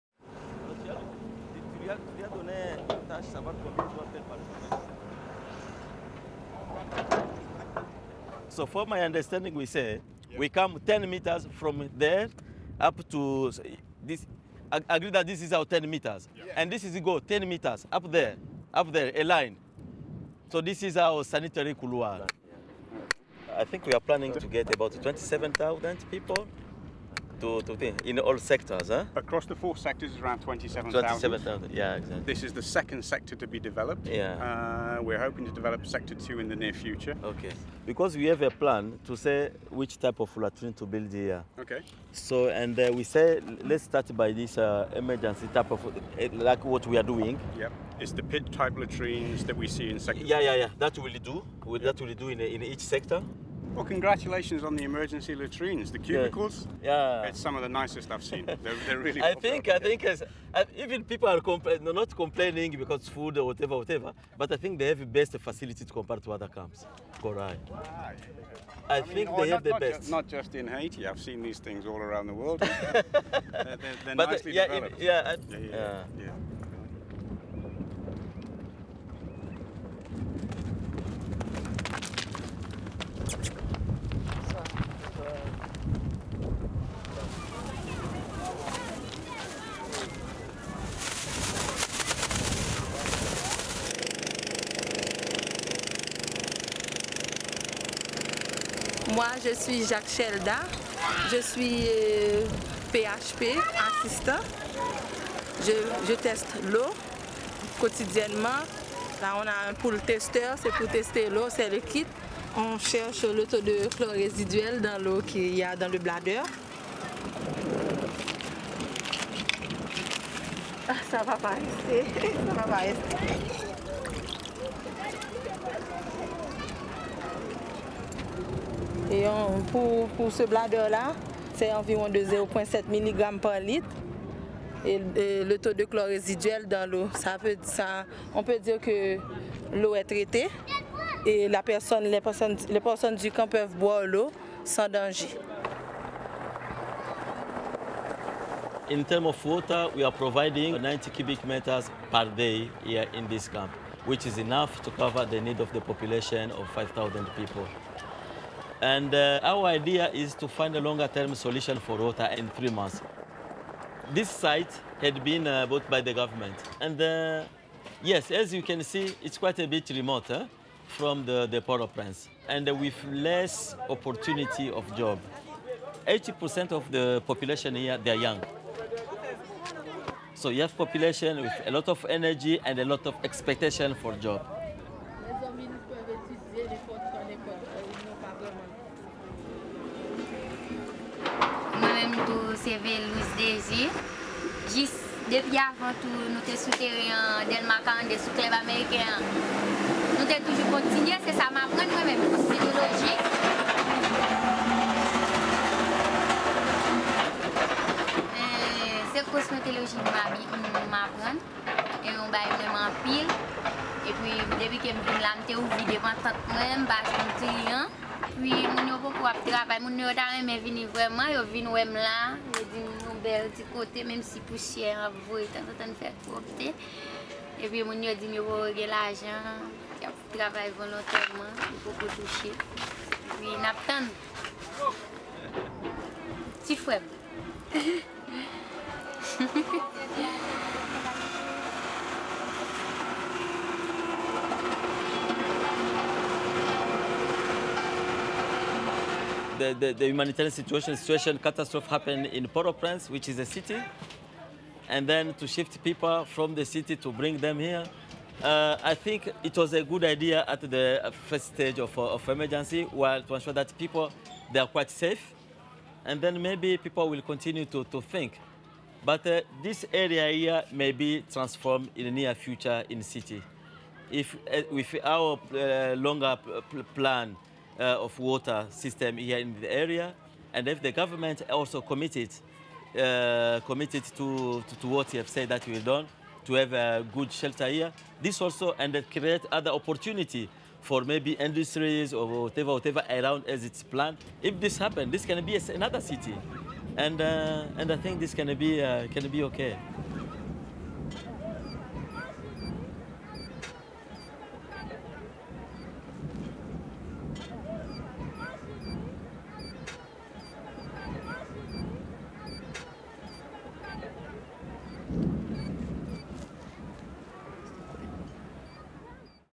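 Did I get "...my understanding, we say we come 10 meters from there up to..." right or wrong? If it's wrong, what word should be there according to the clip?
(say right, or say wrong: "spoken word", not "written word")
right.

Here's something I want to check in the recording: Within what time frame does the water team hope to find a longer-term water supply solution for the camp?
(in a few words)
three months.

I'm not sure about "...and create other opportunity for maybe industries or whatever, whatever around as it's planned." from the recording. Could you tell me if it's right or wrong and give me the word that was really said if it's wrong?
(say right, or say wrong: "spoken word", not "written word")
right.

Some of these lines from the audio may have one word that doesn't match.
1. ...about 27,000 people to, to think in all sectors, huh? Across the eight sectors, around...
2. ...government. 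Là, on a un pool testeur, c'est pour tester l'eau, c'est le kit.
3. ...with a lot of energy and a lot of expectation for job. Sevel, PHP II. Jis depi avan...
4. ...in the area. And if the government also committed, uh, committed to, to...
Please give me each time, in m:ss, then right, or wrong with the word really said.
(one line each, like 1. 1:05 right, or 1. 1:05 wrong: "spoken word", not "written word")
1. 0:24 wrong: "four", not "eight"
2. 1:47 wrong: "quotidiennement", not "government"
3. 3:01 wrong: "Louis", not "PHP"
4. 4:39 right.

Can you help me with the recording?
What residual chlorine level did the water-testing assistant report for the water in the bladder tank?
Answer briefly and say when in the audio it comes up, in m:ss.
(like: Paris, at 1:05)
0.7 mg per litre, at 2:12.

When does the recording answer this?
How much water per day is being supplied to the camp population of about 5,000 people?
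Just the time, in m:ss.
2:30.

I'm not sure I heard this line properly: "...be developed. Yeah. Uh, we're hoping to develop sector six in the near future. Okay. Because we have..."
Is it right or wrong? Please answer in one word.
wrong.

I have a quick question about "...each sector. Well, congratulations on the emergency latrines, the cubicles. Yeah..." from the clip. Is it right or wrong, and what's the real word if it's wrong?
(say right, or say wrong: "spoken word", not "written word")
right.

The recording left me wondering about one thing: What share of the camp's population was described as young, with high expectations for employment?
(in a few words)
80%.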